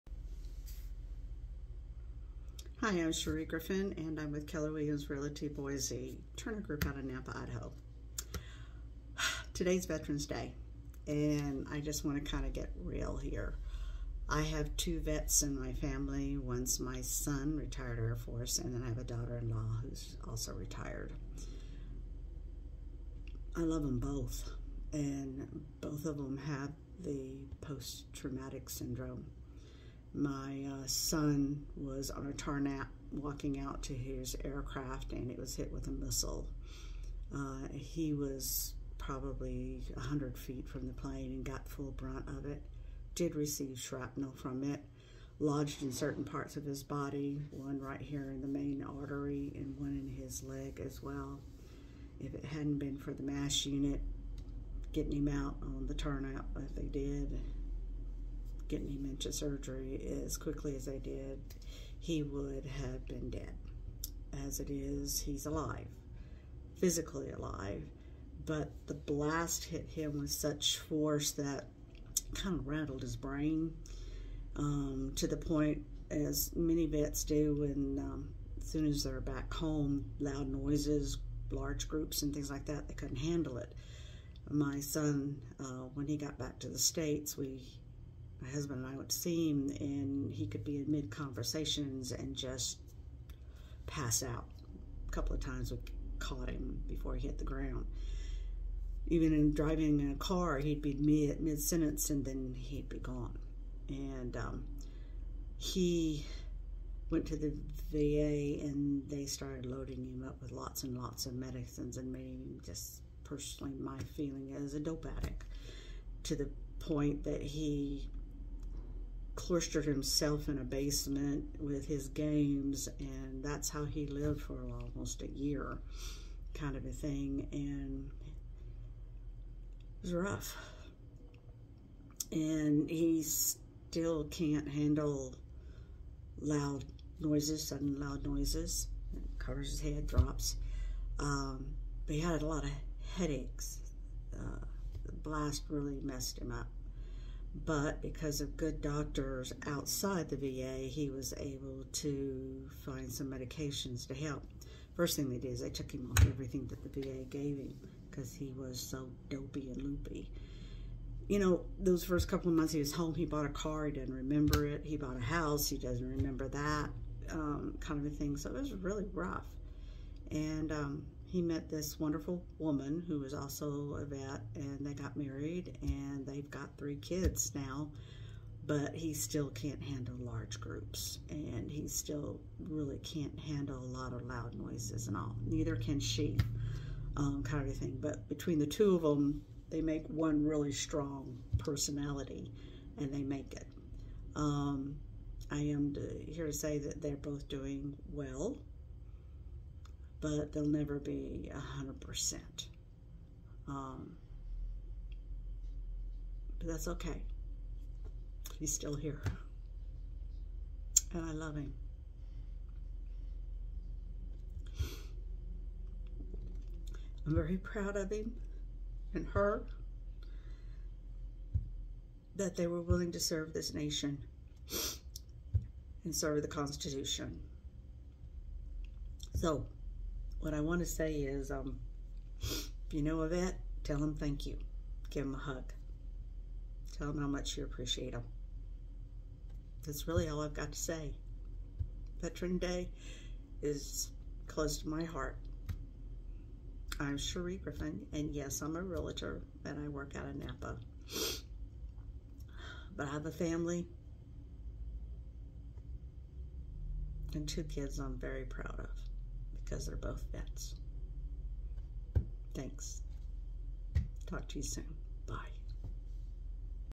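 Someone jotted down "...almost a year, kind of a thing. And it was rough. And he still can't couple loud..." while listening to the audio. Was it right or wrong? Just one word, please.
wrong.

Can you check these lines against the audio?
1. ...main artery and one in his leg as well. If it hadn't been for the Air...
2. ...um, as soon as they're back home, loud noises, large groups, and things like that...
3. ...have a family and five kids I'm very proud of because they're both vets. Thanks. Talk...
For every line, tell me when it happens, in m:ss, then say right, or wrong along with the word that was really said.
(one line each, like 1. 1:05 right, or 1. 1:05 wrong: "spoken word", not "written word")
1. 0:48 wrong: "MASH", not "Air"
2. 1:17 right
3. 4:13 wrong: "two", not "five".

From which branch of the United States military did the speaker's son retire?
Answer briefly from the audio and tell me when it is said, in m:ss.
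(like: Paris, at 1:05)
Air Force, at 0:17.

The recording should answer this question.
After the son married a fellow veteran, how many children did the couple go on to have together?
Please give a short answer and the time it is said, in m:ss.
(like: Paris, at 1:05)
3, at 2:56.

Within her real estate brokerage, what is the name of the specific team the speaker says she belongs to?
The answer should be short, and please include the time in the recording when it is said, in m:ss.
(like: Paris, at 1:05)
Turner Group, at 0:06.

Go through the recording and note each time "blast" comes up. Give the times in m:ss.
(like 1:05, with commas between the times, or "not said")
1:08, 2:25.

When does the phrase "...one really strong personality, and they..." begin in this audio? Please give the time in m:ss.
3:10.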